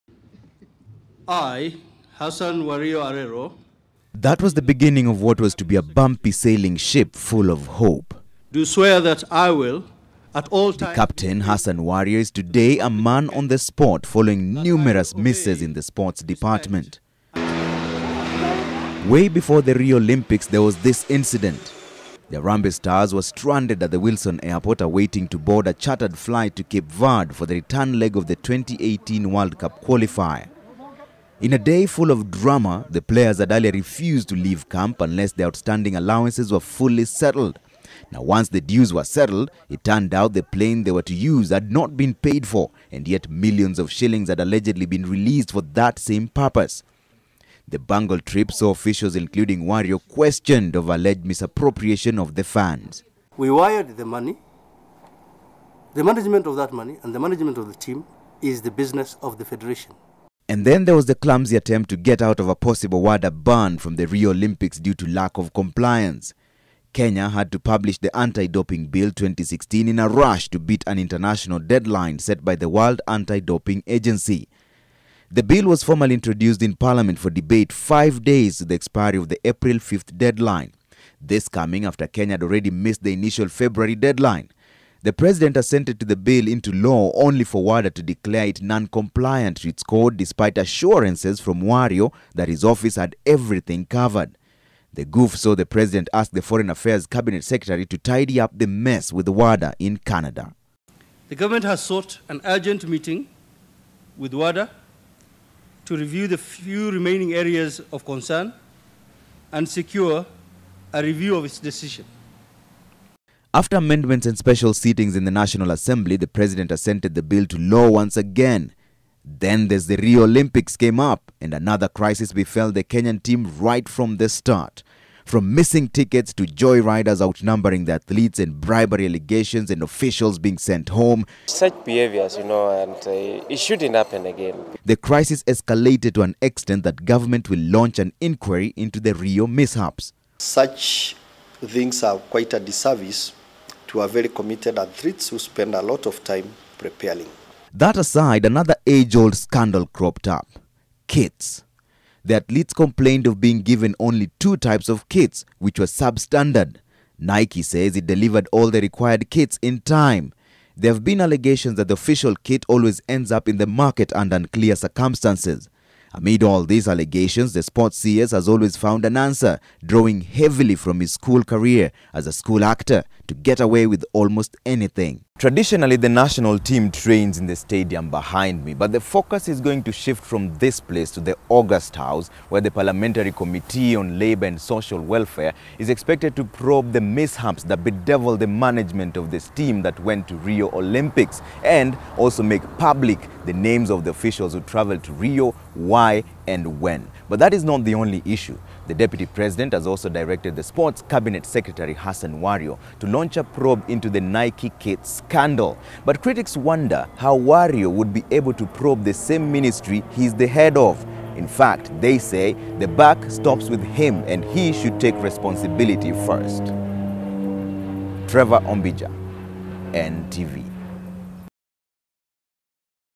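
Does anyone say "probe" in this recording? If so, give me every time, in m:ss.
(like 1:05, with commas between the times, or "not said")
3:06, 3:23, 3:28.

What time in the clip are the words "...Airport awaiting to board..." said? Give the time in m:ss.
0:24.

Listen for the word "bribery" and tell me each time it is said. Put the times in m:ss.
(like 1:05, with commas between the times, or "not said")
2:08.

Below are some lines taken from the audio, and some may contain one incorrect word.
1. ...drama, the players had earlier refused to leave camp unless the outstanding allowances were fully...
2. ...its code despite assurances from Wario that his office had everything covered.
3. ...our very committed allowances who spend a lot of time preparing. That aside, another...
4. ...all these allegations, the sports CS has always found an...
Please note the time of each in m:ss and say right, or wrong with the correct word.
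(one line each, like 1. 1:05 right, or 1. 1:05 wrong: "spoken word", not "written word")
1. 0:32 right
2. 1:29 right
3. 2:23 wrong: "athletes", not "allowances"
4. 2:46 right.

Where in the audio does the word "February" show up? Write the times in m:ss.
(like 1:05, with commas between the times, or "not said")
1:23.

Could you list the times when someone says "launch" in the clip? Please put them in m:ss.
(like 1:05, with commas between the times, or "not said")
2:17, 3:23.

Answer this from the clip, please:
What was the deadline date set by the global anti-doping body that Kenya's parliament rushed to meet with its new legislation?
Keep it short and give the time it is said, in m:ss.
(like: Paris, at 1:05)
April 5th, at 1:19.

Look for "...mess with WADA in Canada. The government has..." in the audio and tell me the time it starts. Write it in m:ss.
1:38.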